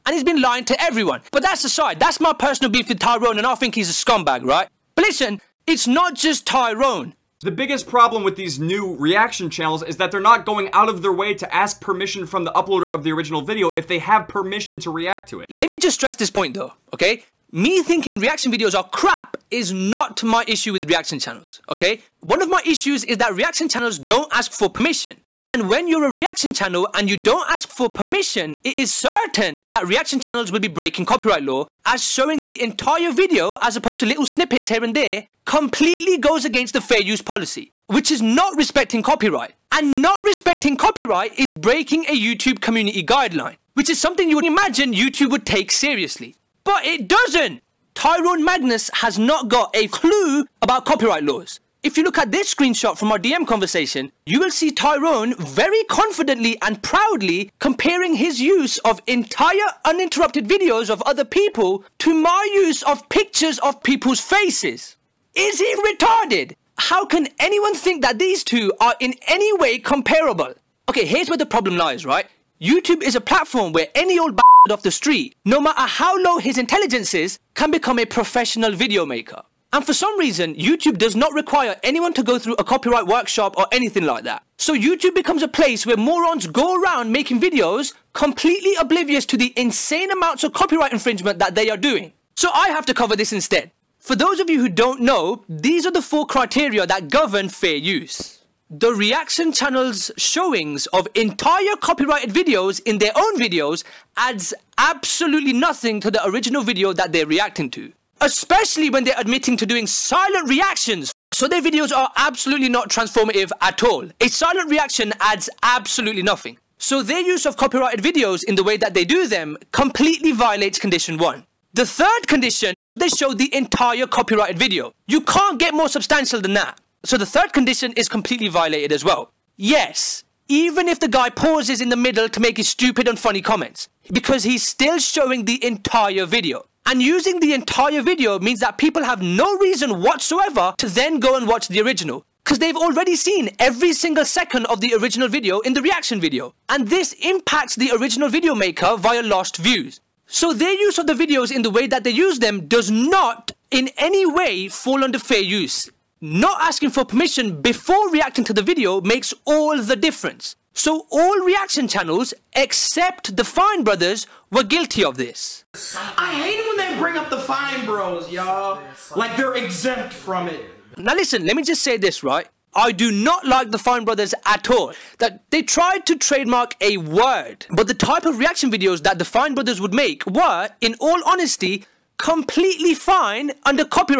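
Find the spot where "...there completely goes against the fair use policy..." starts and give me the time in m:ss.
0:34.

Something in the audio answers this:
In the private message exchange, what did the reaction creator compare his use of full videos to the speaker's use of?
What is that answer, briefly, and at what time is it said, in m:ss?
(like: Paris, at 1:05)
pictures of people's faces, at 1:03.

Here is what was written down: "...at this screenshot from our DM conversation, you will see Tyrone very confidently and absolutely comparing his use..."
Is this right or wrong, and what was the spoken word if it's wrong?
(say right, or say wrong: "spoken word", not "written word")
wrong: "proudly", not "absolutely".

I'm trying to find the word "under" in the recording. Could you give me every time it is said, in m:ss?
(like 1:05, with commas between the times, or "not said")
2:35, 3:03.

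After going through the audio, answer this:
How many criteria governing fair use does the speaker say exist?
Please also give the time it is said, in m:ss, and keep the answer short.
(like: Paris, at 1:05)
4, at 1:36.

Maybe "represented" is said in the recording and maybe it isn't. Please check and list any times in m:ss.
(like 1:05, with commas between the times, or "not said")
not said.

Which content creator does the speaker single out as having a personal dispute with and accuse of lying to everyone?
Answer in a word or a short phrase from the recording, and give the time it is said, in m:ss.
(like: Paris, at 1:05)
Tyrone Magnus, at 0:47.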